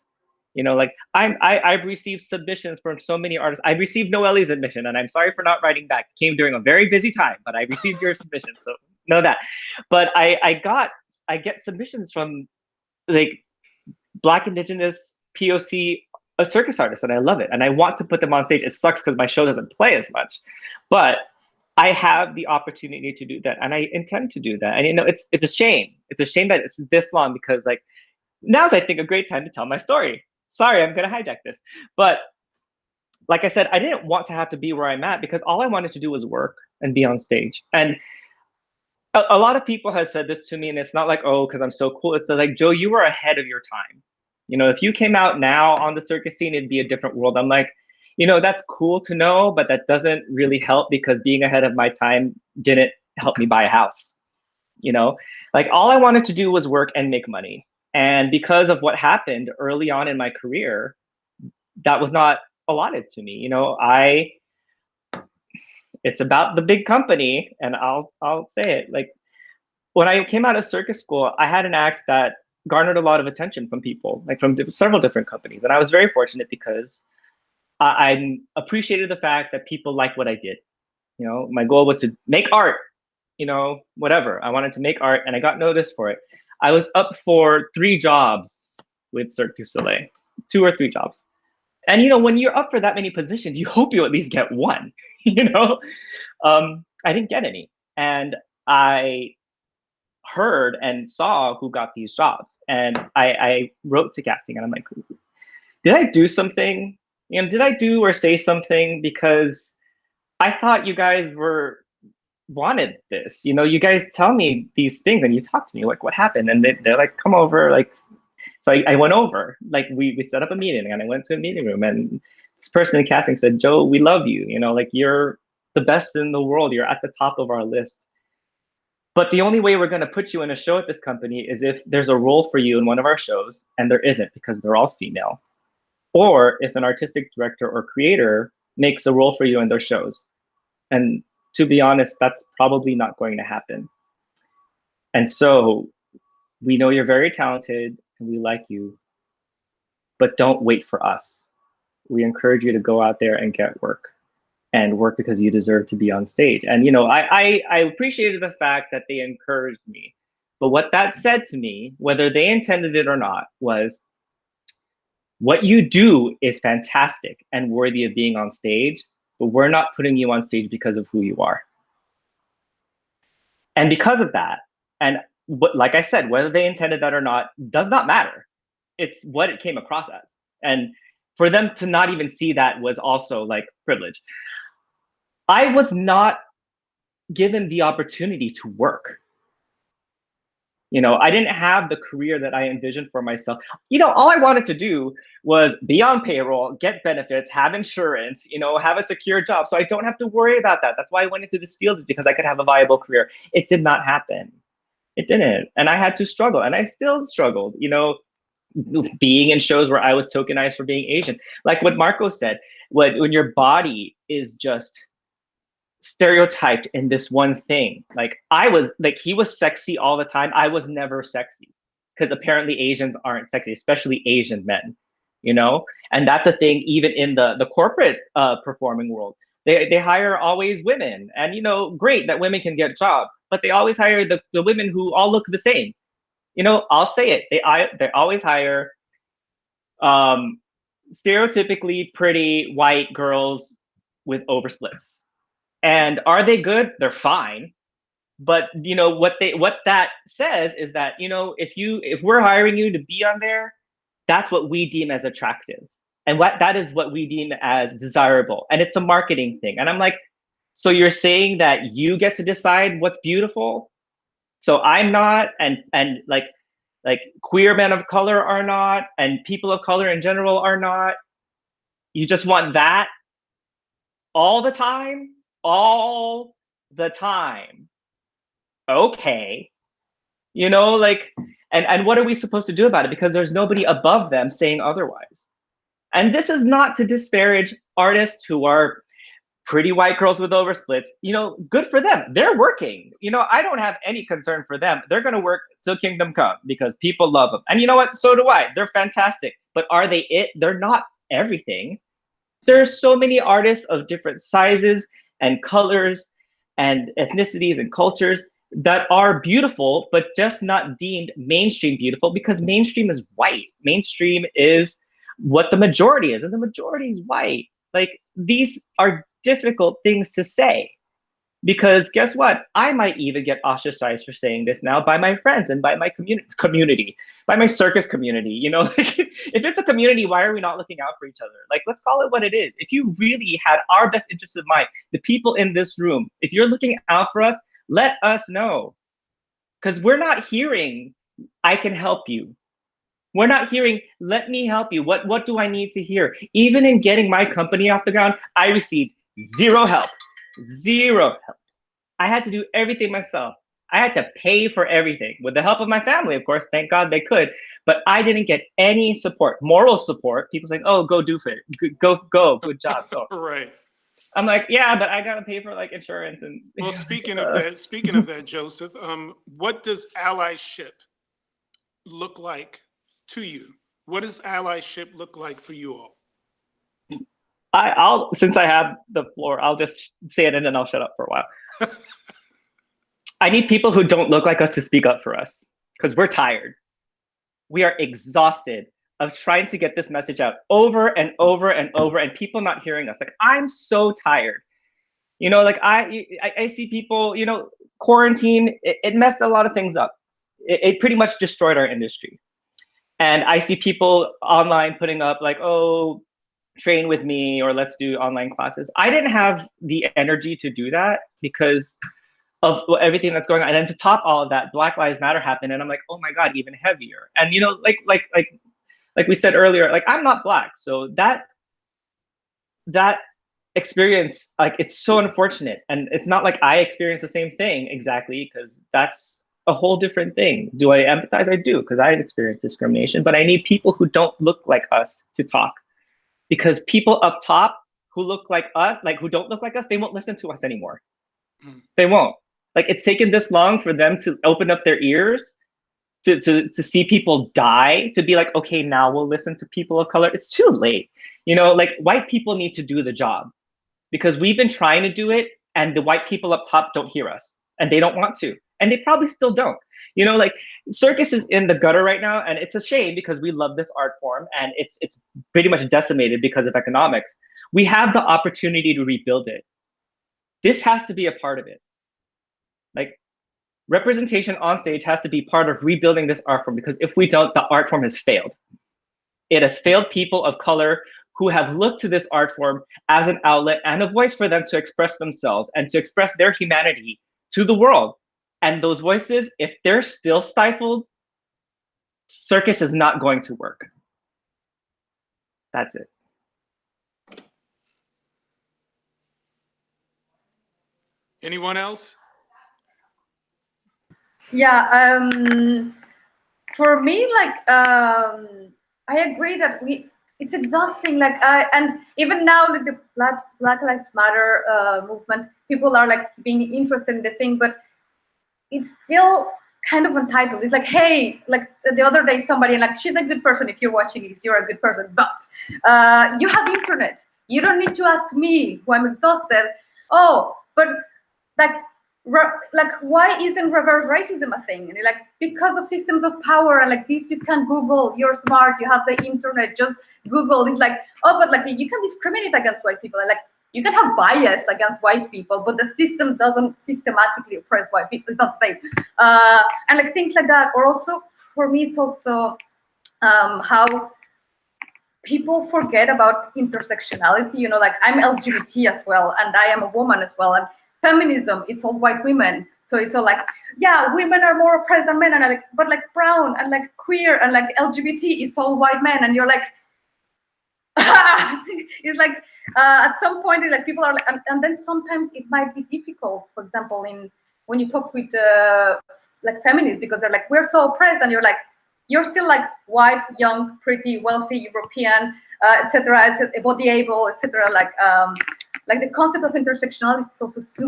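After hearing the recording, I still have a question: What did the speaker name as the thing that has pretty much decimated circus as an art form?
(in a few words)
Economics.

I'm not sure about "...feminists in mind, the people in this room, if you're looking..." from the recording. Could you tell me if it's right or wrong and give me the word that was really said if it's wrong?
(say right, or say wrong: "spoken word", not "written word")
wrong: "interests", not "feminists".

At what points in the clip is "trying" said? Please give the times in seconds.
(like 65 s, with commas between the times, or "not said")
389 s, 454 s.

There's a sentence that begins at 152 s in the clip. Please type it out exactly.
We encourage you to go out there and get work and work because you deserve to be on stage.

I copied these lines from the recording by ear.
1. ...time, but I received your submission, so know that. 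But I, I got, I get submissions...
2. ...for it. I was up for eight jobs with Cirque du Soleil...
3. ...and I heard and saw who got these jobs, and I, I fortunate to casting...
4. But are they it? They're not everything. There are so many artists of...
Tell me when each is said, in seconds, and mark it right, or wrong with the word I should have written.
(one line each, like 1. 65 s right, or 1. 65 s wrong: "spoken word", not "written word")
1. 7 s right
2. 85 s wrong: "three", not "eight"
3. 97 s wrong: "wrote", not "fortunate"
4. 299 s right.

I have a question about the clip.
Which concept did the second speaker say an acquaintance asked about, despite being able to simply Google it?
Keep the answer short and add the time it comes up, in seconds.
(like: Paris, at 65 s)
Reverse racism, at 533 s.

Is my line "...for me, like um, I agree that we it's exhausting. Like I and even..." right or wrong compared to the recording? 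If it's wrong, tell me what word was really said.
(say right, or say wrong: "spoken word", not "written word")
right.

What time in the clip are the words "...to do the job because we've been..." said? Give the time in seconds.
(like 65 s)
452 s.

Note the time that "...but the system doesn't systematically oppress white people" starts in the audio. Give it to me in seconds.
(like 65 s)
545 s.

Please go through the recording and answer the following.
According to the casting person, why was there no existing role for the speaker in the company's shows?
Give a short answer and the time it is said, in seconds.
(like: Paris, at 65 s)
They're all female, at 134 s.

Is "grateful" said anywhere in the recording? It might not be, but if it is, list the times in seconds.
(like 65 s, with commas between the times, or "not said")
not said.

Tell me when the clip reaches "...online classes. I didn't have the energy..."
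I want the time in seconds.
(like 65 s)
408 s.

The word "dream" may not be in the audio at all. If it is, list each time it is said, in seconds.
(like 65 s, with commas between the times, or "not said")
not said.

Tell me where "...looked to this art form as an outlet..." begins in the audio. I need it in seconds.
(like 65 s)
481 s.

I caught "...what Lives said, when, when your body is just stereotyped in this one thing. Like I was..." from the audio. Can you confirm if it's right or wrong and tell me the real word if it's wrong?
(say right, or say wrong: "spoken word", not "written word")
wrong: "Marco", not "Lives".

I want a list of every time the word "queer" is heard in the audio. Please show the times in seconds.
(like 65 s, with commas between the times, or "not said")
267 s, 566 s.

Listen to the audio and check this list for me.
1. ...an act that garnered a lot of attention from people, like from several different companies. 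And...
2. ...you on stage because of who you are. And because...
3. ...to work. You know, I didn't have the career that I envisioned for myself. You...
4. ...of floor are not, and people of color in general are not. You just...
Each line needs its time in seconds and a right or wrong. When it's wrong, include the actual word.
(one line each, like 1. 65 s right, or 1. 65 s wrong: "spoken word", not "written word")
1. 71 s right
2. 170 s right
3. 188 s right
4. 267 s wrong: "color", not "floor".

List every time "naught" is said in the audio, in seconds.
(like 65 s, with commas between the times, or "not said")
not said.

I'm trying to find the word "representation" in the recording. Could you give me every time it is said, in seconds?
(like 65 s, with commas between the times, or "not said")
473 s.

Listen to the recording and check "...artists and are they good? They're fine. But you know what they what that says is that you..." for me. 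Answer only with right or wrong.
wrong.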